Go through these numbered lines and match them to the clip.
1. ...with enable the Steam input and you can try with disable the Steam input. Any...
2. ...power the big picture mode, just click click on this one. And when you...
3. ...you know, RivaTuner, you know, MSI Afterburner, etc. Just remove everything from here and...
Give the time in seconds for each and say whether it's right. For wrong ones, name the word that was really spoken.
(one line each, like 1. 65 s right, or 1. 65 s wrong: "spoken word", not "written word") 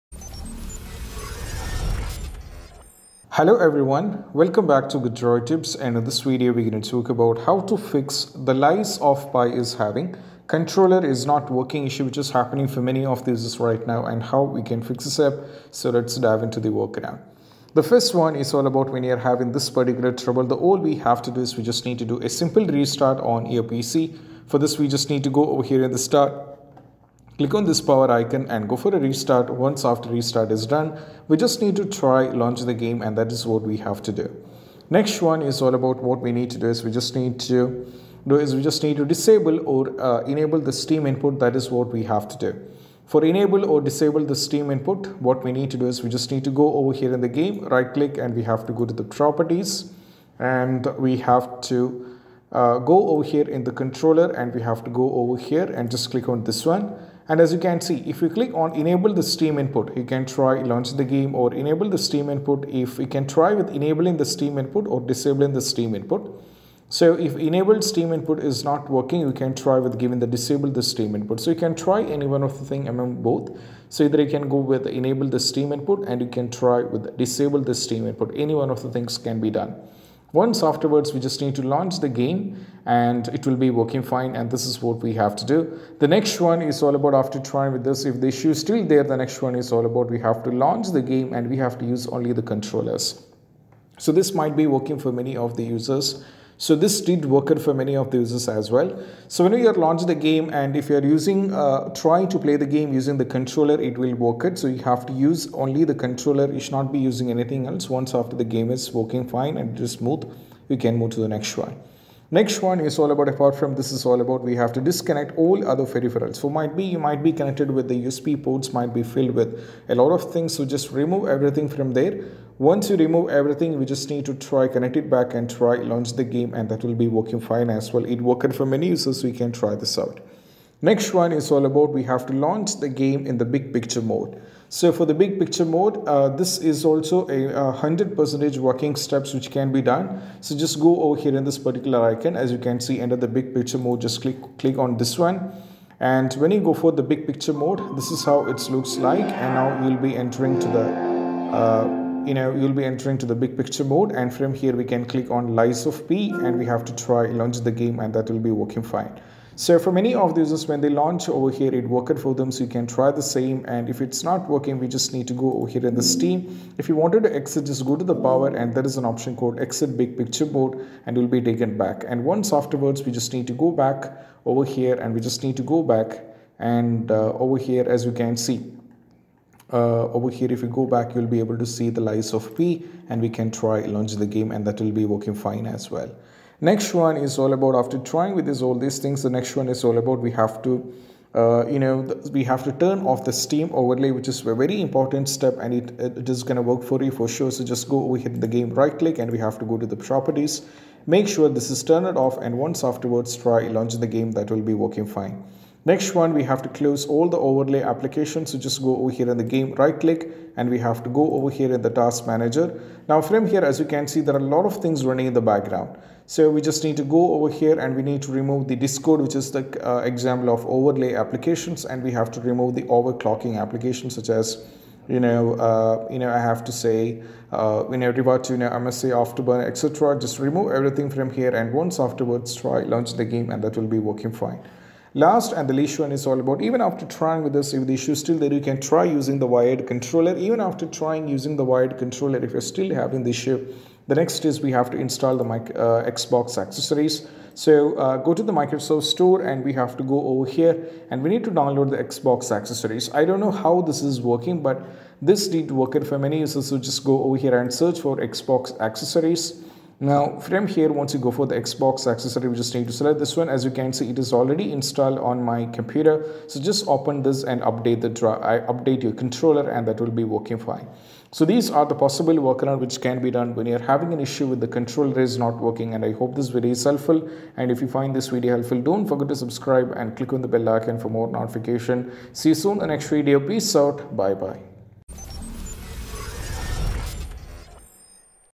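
1. 74 s right
2. 143 s wrong: "under", not "power"
3. 227 s right.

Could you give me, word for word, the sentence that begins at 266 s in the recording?
So just open this and update the I update your controller and that will be working fine.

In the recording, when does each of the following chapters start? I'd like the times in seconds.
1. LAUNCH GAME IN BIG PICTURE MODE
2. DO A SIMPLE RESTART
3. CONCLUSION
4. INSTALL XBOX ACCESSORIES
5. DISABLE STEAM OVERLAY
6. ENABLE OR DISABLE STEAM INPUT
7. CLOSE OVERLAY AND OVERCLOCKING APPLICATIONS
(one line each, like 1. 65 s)
1. 147 s
2. 25 s
3. 283 s
4. 254 s
5. 200 s
6. 58 s
7. 214 s.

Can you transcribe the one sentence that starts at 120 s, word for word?
So just remove everything from there.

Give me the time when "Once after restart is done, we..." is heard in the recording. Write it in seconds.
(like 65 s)
29 s.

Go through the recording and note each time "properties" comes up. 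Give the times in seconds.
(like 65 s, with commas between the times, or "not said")
49 s, 199 s.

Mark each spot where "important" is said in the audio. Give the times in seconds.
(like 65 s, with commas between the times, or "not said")
194 s.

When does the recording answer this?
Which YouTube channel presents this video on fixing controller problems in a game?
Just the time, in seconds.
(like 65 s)
4 s.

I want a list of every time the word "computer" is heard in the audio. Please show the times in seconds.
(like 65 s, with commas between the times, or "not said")
265 s.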